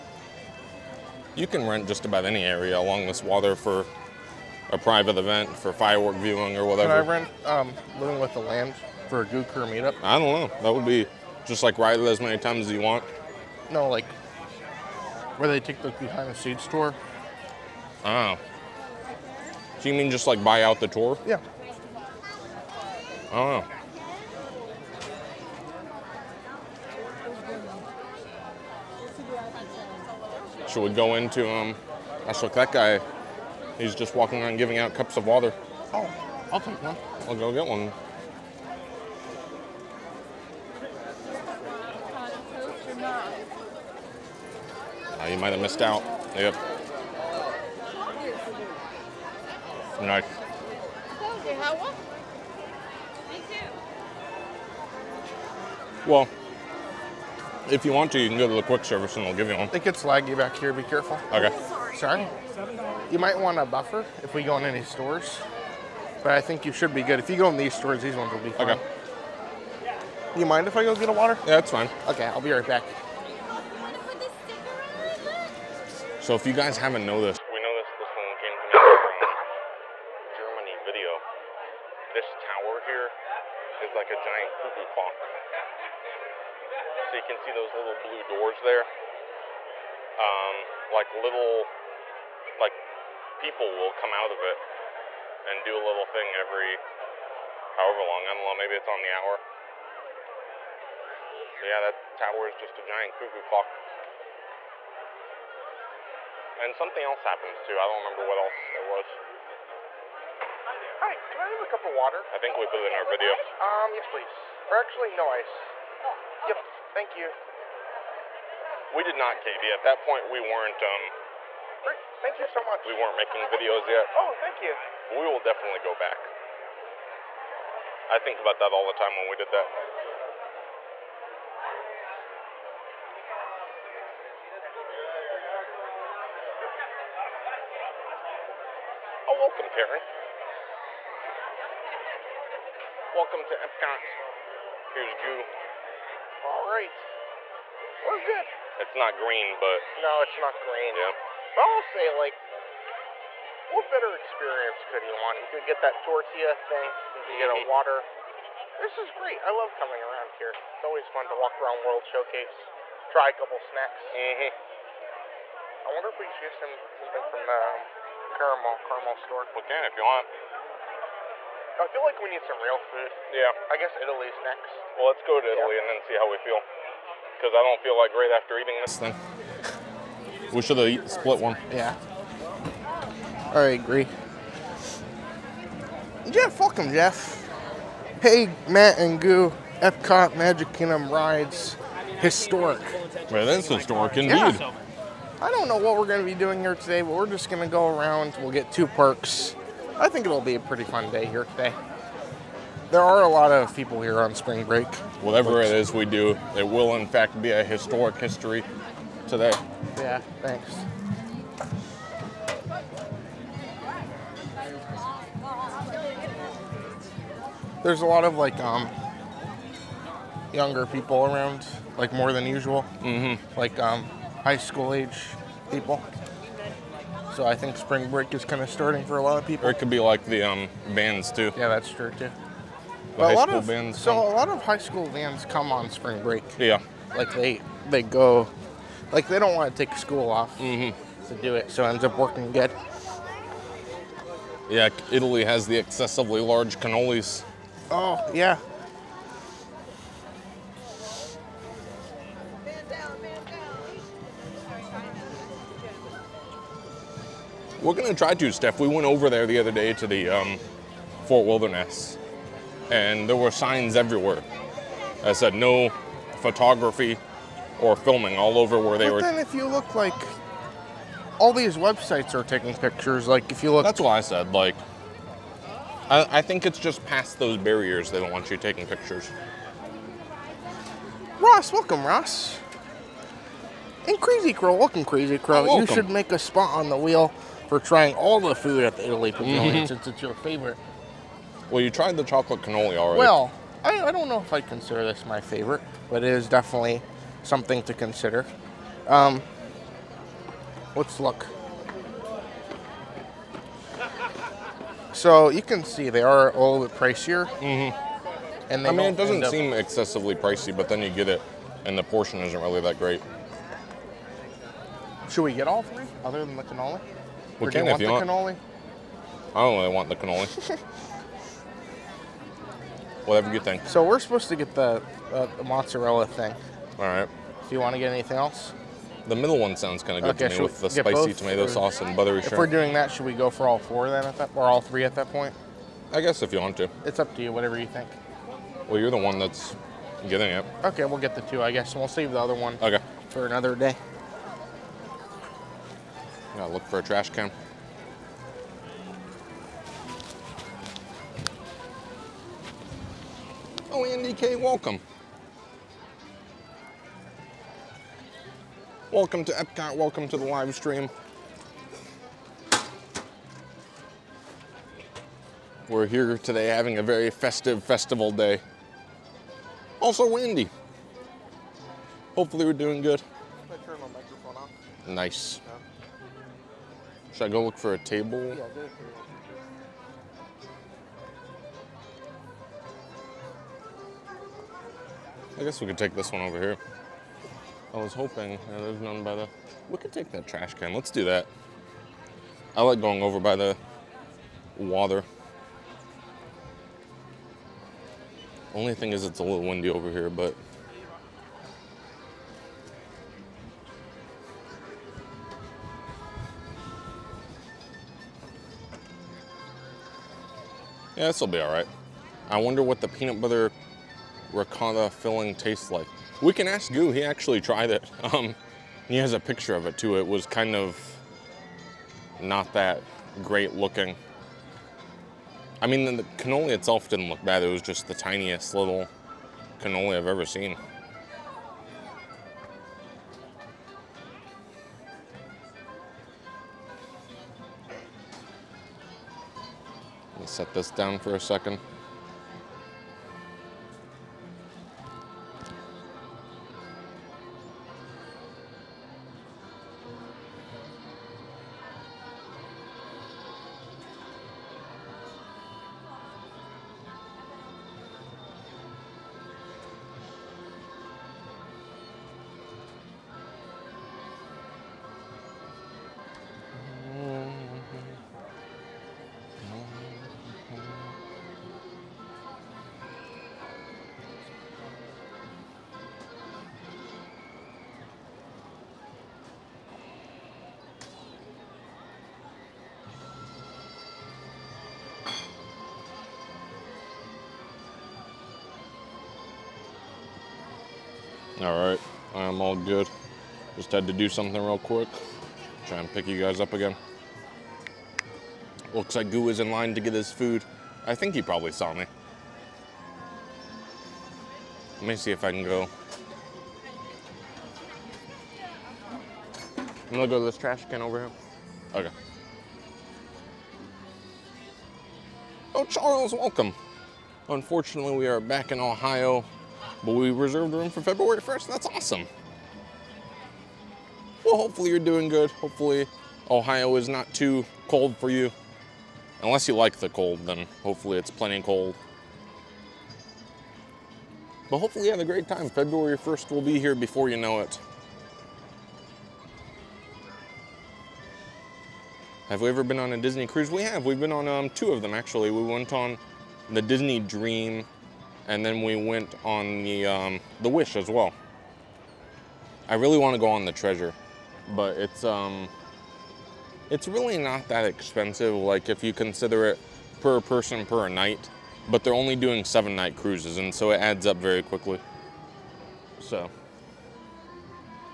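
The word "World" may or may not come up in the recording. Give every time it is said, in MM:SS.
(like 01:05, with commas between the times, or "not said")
02:41.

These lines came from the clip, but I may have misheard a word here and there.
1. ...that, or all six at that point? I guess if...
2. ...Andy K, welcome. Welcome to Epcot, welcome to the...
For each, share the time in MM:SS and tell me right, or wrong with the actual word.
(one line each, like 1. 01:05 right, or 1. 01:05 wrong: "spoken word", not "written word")
1. 05:34 wrong: "three", not "six"
2. 05:54 right.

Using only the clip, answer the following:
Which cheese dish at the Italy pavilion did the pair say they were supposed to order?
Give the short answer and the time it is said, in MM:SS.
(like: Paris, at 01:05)
The mozzarella thing, at 05:25.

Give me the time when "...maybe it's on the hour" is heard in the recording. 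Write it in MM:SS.
01:38.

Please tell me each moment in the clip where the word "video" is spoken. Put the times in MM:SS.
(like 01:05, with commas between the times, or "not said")
01:20, 01:53, 02:03.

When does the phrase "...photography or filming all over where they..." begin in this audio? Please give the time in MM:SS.
04:26.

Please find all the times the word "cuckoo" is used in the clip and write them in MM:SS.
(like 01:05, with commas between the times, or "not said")
01:24, 01:43.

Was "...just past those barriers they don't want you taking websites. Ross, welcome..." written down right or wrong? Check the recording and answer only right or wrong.
wrong.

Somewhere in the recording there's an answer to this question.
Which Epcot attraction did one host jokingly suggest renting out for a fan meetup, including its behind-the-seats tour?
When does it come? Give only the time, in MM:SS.
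00:08.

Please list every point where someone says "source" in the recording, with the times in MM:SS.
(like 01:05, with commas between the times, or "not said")
not said.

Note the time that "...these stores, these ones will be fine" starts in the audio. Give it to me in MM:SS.
01:07.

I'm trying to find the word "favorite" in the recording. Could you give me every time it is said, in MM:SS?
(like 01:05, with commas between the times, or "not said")
04:50, 04:55.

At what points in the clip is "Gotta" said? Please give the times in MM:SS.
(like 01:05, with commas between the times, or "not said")
05:46.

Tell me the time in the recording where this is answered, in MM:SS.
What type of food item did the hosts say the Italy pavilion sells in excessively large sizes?
04:06.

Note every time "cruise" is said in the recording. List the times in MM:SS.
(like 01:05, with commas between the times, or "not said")
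09:03, 09:23.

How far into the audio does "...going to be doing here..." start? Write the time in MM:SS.
03:16.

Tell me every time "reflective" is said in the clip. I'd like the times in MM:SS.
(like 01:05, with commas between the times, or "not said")
not said.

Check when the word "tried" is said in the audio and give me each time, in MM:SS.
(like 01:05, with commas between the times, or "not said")
04:52, 06:57.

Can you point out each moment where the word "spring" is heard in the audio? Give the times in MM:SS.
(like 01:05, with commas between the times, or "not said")
03:24, 03:47, 03:55.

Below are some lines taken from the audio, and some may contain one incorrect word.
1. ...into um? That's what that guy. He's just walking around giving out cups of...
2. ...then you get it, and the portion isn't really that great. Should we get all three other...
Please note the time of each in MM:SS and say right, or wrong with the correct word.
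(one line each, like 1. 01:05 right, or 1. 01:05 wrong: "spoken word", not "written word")
1. 00:31 right
2. 05:10 right.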